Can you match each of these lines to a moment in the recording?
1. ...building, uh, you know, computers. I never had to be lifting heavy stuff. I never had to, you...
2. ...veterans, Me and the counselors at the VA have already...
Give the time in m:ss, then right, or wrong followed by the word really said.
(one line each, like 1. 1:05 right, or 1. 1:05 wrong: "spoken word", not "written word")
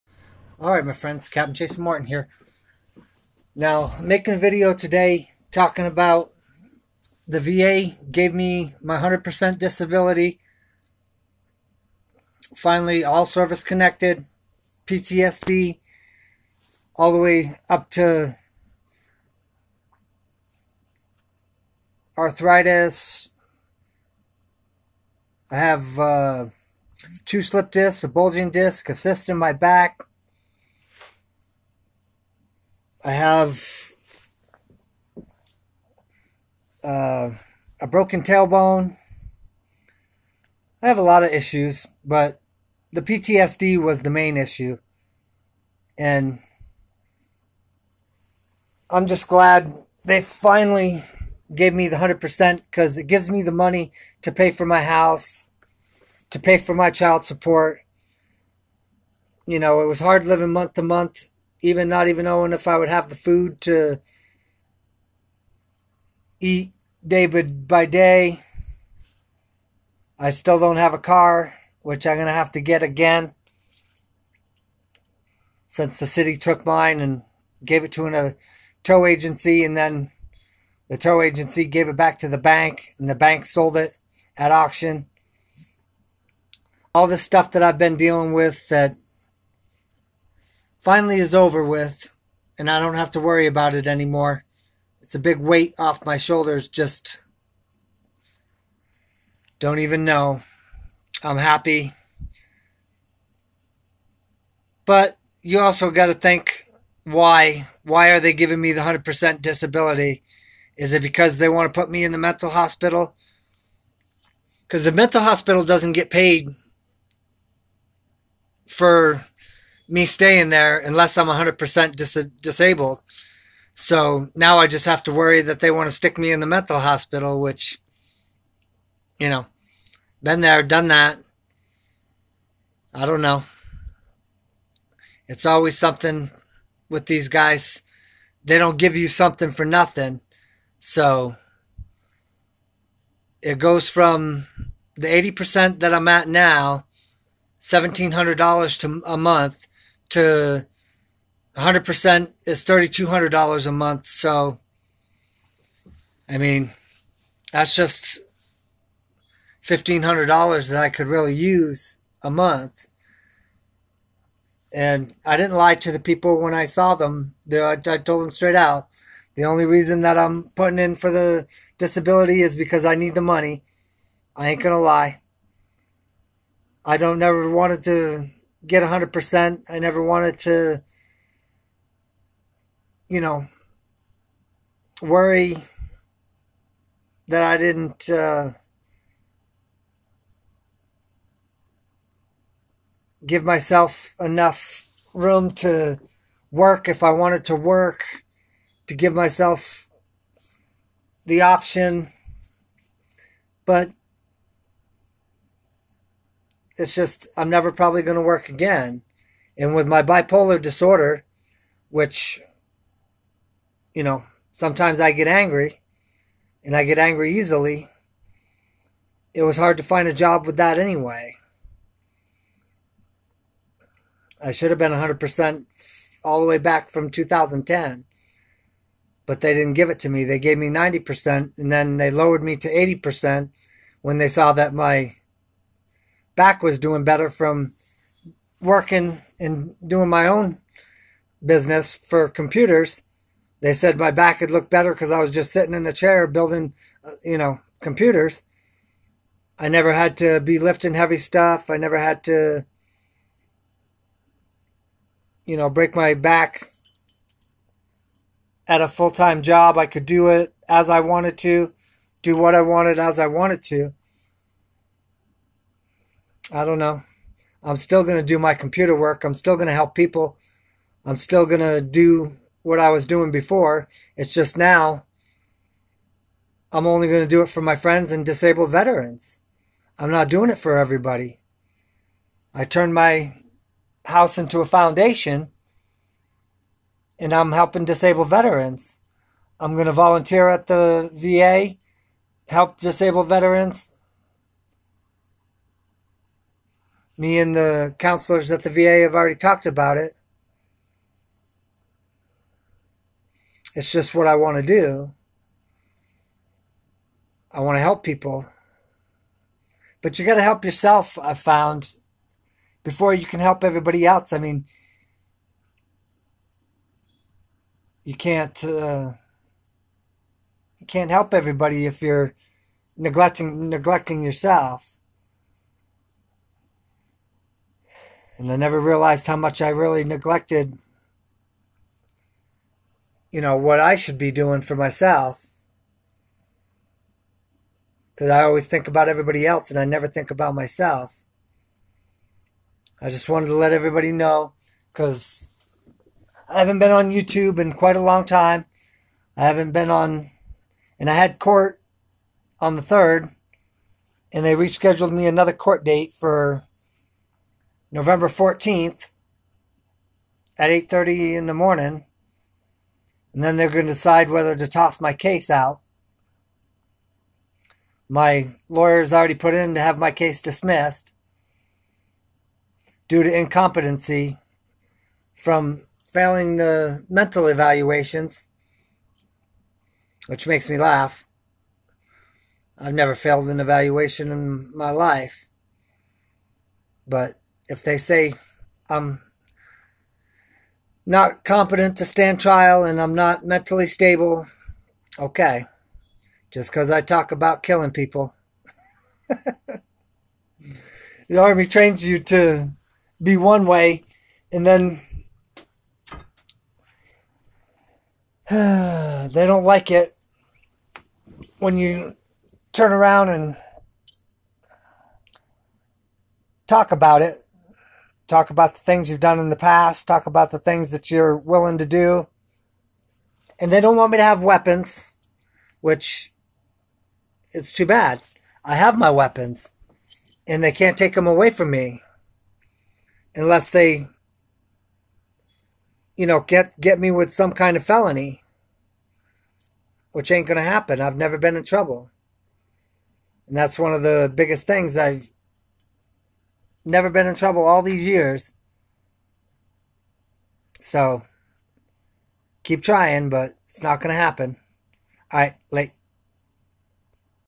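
1. 4:06 right
2. 4:53 right.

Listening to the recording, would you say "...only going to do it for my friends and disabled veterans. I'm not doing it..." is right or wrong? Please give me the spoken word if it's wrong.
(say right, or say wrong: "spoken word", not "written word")
right.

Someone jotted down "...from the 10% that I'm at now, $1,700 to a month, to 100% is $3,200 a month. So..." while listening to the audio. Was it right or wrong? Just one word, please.
wrong.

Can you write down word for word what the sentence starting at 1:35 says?
It's a big weight off my shoulders, just don't even know.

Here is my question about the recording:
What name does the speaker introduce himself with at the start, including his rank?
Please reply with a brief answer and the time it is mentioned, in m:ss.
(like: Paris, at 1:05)
Captain Jason Morton, at 0:01.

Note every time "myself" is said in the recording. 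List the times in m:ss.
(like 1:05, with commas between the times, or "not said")
3:13, 3:19, 5:34, 5:40.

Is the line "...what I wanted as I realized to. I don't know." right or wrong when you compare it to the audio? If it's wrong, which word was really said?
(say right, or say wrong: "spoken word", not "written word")
wrong: "wanted", not "realized".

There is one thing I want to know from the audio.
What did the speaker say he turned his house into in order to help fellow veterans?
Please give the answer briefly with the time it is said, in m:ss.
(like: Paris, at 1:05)
A foundation, at 4:44.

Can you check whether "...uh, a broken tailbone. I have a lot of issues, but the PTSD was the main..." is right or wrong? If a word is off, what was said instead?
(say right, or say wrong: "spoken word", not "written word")
right.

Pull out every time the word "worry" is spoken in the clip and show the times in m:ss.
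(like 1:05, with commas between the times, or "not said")
1:33, 2:05, 3:05.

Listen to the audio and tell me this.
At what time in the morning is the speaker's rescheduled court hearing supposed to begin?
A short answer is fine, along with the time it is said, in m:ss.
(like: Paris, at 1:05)
8:30, at 6:00.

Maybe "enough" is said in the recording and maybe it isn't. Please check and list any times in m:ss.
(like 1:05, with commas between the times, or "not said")
3:14.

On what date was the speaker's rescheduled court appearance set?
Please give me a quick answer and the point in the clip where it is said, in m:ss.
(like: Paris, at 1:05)
November 14, at 5:57.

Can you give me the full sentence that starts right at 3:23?
But it's just I'm never probably going to work again.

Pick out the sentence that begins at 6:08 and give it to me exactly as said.
My lawyer's already put in to have my case dismissed due to incompetency from failing the mental evaluations, which makes me laugh.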